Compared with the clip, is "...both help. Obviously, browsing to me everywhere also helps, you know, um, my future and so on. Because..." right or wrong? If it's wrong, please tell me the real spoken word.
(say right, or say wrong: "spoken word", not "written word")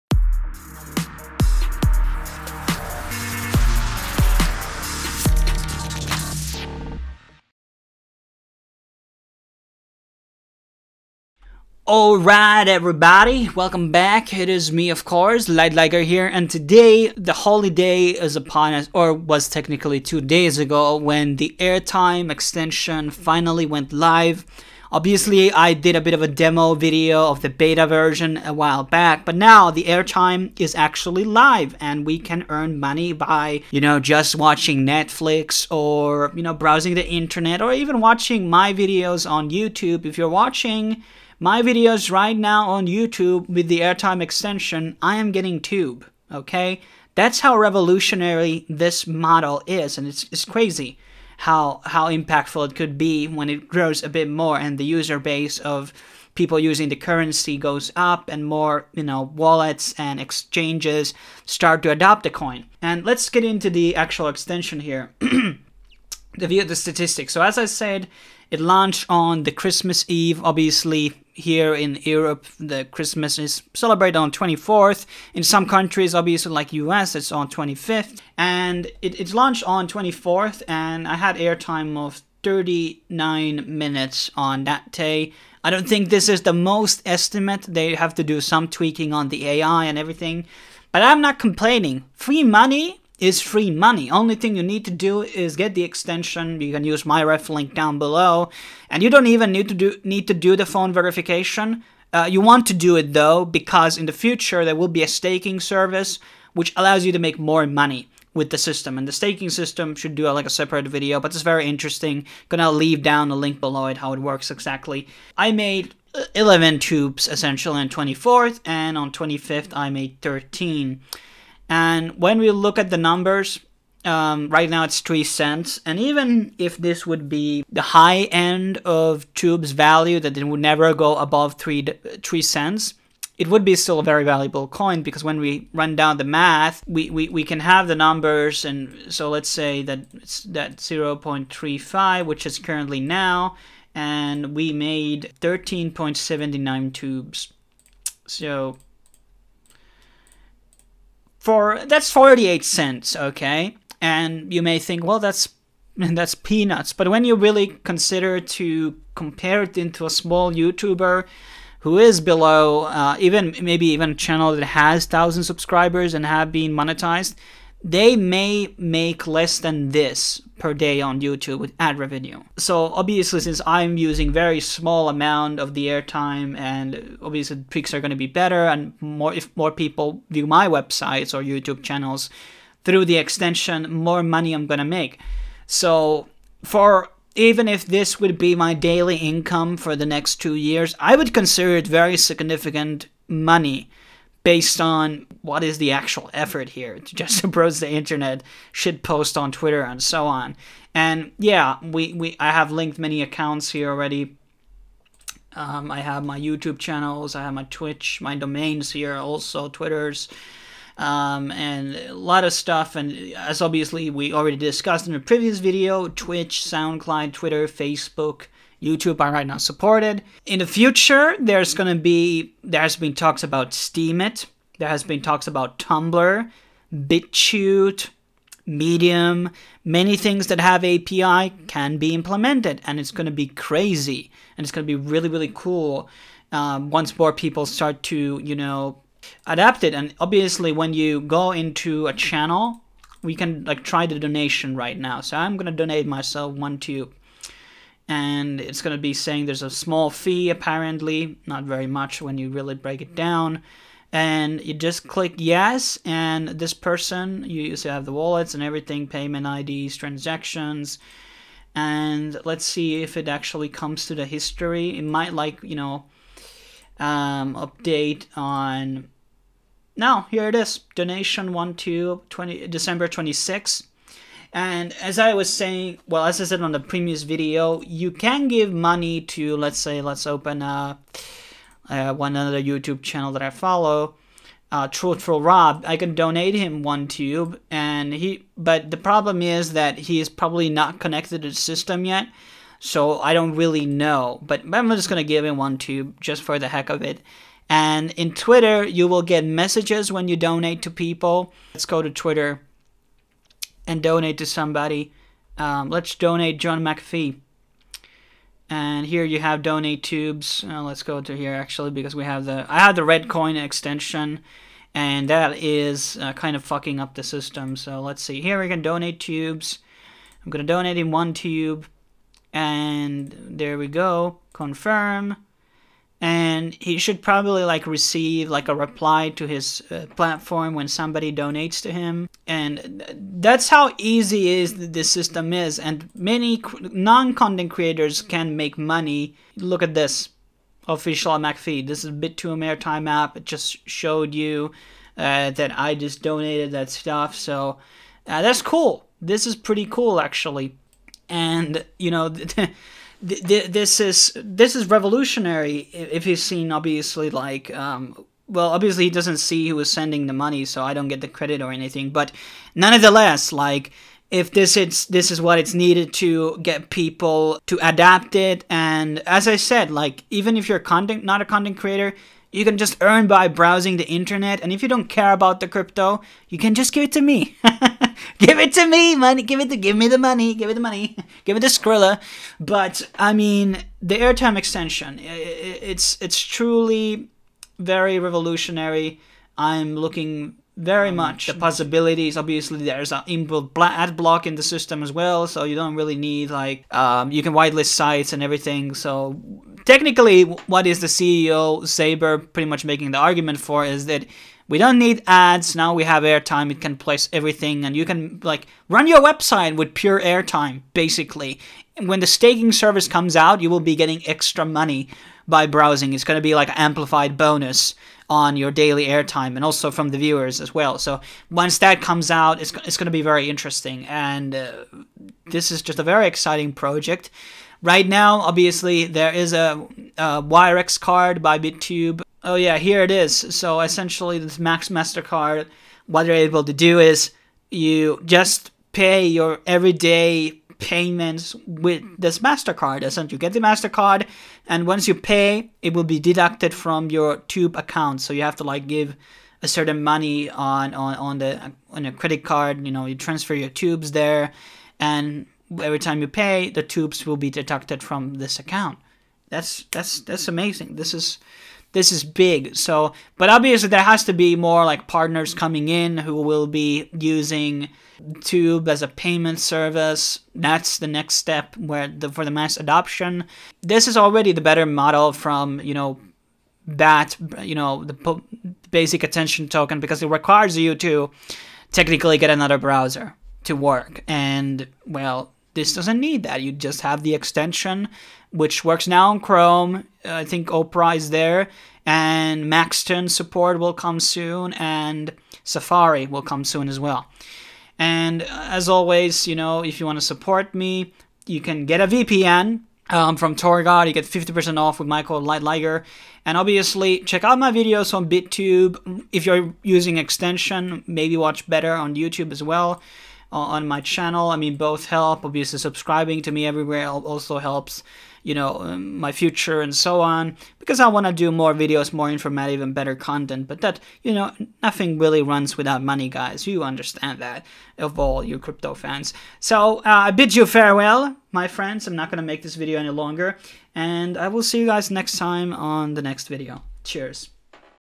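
wrong: "subscribing", not "browsing".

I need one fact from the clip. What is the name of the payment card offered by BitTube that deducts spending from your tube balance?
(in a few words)
WireX card.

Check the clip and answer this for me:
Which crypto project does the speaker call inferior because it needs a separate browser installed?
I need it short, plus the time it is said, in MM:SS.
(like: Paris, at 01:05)
basic attention token, at 07:58.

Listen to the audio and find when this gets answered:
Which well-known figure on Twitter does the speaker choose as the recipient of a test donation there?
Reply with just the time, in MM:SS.
05:06.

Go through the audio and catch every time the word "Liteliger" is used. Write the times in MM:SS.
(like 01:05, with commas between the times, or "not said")
00:15, 08:25.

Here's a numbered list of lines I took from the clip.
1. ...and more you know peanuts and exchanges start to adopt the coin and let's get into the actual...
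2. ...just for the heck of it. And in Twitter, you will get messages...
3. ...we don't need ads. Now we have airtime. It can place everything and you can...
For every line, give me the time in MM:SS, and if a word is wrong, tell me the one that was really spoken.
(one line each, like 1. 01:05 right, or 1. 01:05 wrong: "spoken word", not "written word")
1. 00:58 wrong: "wallets", not "peanuts"
2. 04:56 right
3. 06:44 right.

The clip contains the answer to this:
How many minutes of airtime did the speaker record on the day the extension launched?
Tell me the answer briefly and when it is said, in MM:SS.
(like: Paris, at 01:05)
39 minutes, at 01:22.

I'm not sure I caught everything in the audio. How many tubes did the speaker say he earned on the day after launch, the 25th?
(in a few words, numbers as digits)
13.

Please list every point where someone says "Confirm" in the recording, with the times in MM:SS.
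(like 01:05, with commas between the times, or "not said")
05:24.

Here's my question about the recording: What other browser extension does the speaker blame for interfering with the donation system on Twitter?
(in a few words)
red coin extension.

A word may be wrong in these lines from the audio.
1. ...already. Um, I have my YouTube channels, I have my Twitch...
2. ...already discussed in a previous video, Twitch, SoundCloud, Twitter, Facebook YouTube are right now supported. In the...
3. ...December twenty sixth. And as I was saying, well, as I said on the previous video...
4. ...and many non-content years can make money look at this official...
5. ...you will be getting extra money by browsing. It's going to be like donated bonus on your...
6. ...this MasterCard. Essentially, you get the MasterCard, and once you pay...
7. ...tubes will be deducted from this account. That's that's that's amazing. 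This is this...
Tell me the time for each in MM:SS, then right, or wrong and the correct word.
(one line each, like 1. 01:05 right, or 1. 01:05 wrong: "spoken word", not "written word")
1. 03:23 right
2. 03:34 right
3. 04:32 right
4. 05:35 wrong: "creators", not "years"
5. 06:53 wrong: "amplified", not "donated"
6. 07:22 right
7. 07:36 right.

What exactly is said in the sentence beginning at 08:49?
So uh, I bid you farewell, my friends.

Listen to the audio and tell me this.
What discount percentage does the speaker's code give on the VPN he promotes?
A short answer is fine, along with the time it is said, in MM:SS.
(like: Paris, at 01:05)
50%, at 08:24.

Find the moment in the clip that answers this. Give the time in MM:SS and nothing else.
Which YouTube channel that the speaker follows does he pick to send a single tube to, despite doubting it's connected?
04:44.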